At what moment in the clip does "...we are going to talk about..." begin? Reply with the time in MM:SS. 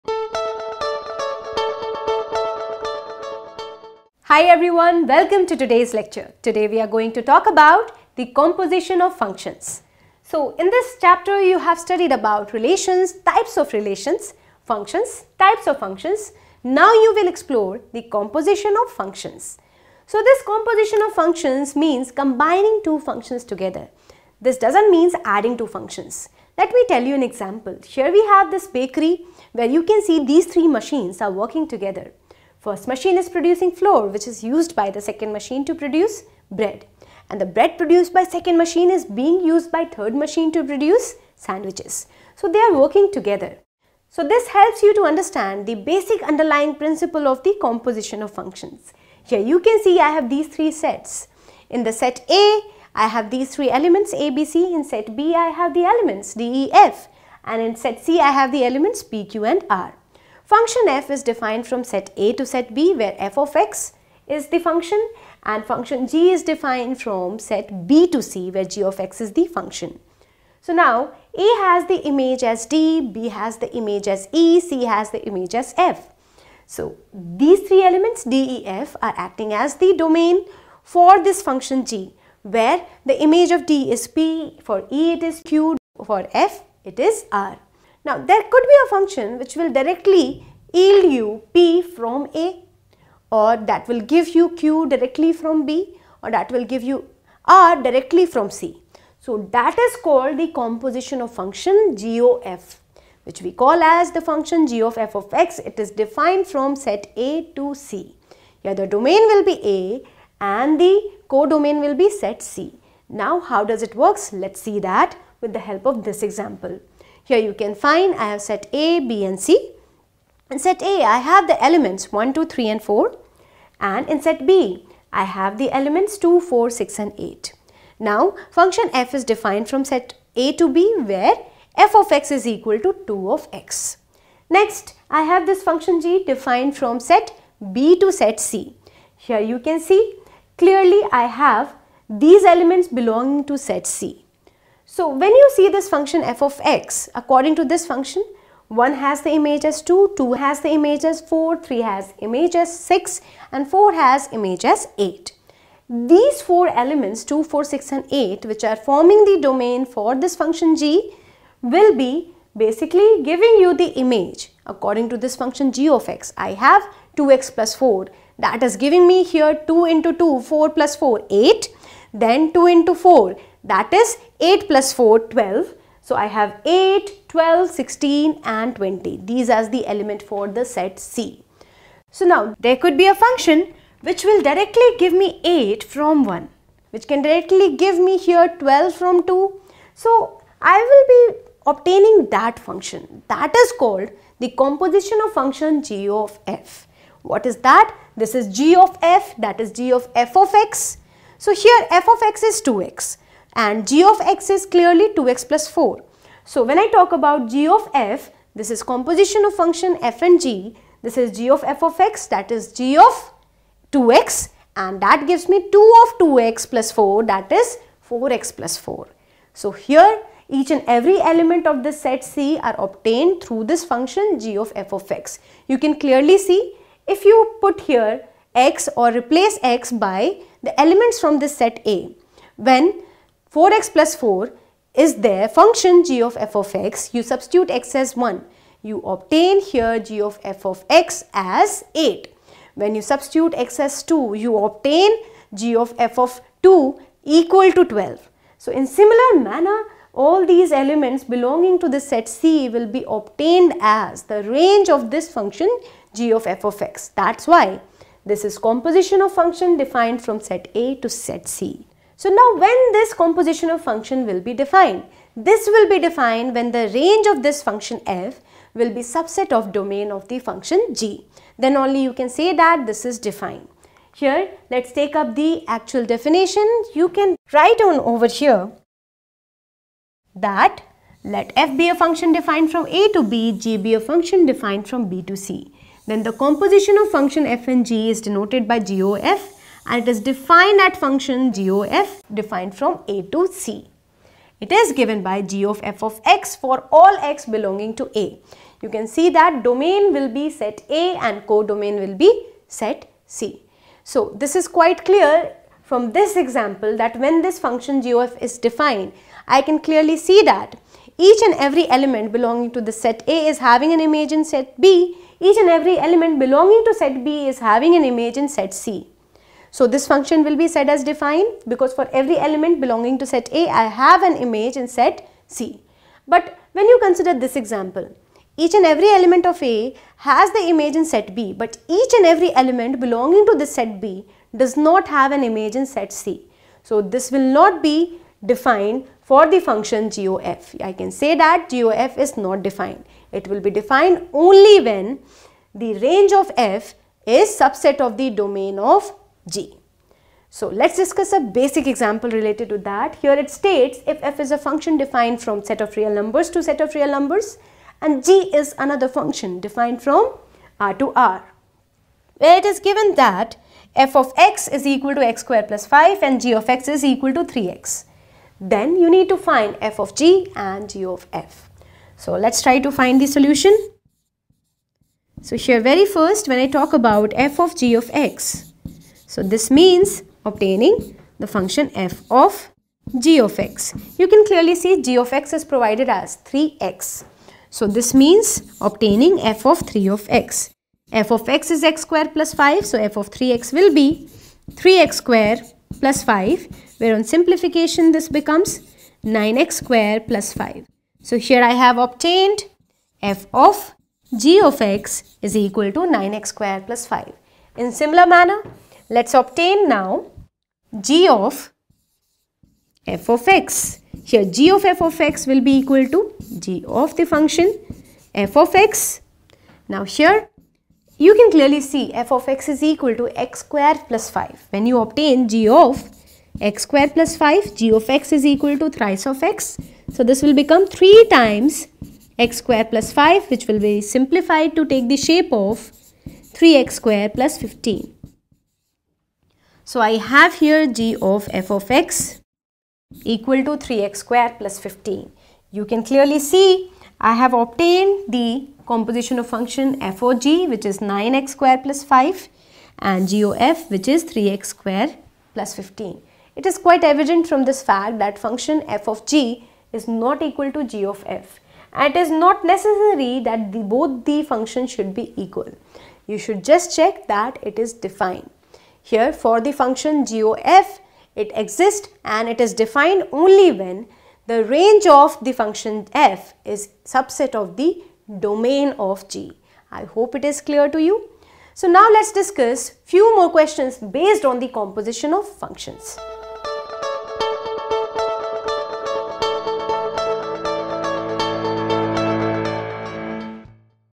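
00:06.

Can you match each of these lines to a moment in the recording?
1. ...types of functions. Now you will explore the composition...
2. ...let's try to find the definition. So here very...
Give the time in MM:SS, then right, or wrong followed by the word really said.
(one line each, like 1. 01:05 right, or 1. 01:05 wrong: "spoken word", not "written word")
1. 00:15 right
2. 06:12 wrong: "solution", not "definition".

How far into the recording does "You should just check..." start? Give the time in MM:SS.
07:46.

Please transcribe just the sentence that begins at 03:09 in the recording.
So I will be obtaining that function that is called the composition of function g of f.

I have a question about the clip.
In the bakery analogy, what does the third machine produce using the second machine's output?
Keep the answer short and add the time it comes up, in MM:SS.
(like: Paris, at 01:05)
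sandwiches, at 00:41.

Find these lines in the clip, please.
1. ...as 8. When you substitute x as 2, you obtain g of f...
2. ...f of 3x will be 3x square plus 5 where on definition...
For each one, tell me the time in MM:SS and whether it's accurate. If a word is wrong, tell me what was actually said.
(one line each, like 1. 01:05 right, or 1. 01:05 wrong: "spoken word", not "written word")
1. 04:01 right
2. 06:32 wrong: "simplification", not "definition".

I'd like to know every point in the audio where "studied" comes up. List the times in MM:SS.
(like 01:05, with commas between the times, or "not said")
00:11.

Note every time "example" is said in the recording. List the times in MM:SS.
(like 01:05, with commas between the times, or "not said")
00:27, 01:56, 05:06, 05:27, 05:51.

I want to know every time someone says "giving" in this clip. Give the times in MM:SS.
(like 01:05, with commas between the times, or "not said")
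02:43, 02:48.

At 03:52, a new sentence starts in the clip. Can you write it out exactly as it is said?
When 4x plus 4 is their function g of f of x.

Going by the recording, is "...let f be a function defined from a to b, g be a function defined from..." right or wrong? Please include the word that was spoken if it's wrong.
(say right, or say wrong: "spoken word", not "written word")
right.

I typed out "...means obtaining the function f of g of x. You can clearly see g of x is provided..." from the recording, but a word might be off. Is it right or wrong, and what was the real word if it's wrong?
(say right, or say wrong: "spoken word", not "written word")
right.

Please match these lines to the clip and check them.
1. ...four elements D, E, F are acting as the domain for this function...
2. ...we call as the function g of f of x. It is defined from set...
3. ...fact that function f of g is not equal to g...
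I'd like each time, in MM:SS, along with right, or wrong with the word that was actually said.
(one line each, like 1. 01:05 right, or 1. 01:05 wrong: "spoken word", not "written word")
1. 01:17 wrong: "three", not "four"
2. 01:43 right
3. 07:37 right.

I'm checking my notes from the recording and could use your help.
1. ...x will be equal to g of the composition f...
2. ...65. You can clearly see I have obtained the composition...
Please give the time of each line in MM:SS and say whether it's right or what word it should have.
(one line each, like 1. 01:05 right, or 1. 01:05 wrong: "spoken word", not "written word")
1. 06:55 wrong: "function", not "composition"
2. 07:24 wrong: "15", not "65".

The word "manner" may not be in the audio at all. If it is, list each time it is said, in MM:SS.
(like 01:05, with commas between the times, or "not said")
04:09, 06:48.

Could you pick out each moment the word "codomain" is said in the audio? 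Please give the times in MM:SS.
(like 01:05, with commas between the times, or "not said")
01:51, 05:01.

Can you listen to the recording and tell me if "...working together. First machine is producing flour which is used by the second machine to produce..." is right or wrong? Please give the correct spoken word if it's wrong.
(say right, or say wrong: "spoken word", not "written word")
right.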